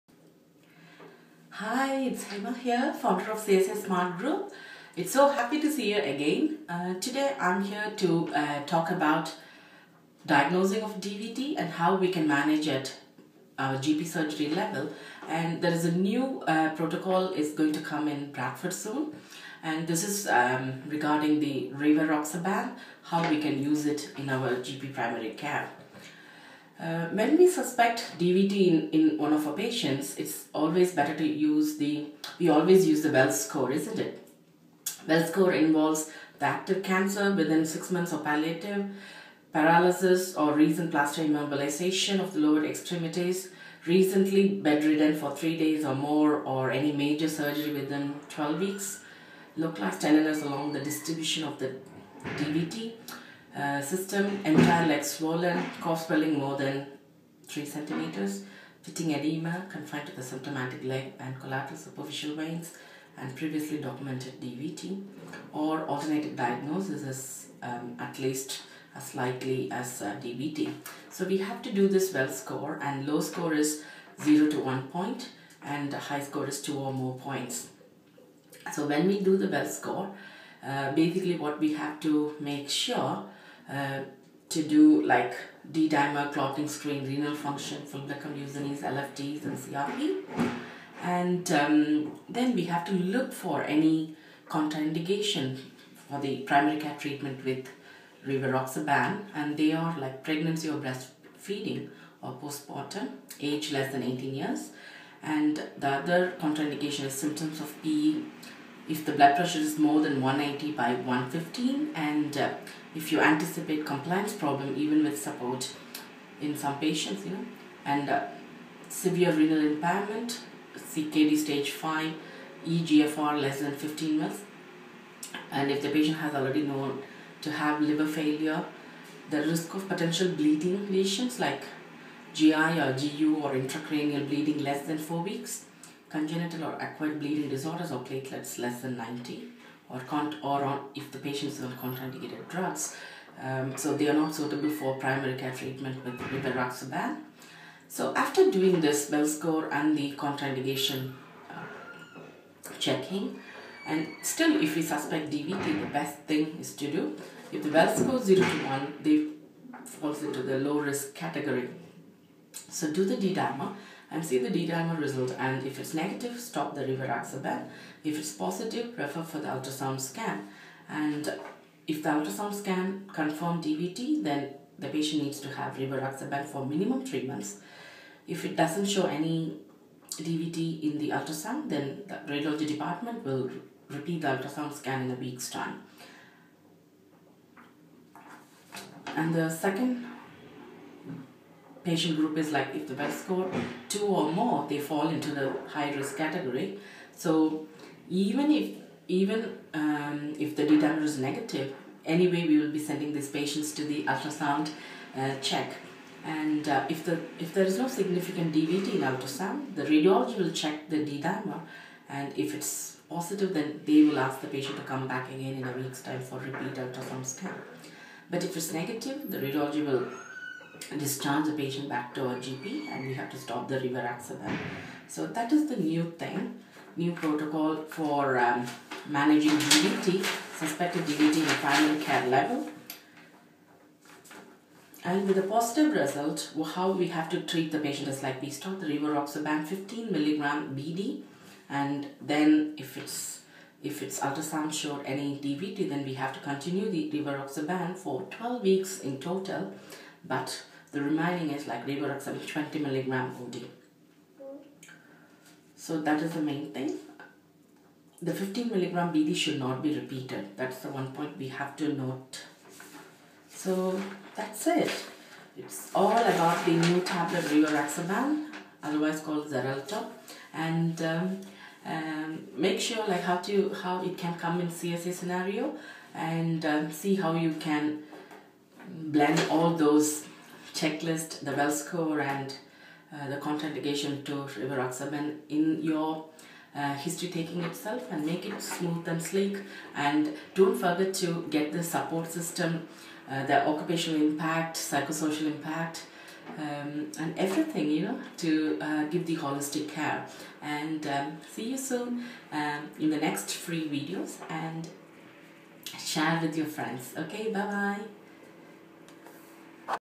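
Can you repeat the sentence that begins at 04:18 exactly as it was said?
The 15 milligram BD should not be repeated.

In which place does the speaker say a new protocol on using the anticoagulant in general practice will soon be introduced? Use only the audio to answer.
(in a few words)
Bradford.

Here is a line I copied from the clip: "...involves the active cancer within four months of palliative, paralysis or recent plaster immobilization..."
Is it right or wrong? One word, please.
wrong.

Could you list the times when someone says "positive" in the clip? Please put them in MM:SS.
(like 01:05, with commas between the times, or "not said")
02:48, 03:33, 03:55.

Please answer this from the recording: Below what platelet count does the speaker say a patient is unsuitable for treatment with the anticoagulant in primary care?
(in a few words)
90.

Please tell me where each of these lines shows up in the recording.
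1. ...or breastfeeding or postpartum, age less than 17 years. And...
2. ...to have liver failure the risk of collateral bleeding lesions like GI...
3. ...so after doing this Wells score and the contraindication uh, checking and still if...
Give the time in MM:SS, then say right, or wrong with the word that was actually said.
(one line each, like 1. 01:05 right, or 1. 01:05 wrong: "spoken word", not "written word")
1. 01:40 wrong: "18", not "17"
2. 02:07 wrong: "potential", not "collateral"
3. 02:27 right.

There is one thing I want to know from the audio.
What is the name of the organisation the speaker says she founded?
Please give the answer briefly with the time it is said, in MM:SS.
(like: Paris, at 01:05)
CSA Smart Group, at 00:03.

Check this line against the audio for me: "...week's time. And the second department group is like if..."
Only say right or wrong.
wrong.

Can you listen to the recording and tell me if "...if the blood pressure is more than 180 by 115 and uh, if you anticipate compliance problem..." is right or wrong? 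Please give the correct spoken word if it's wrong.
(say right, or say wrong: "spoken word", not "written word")
right.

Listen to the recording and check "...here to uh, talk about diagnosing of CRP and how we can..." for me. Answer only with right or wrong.
wrong.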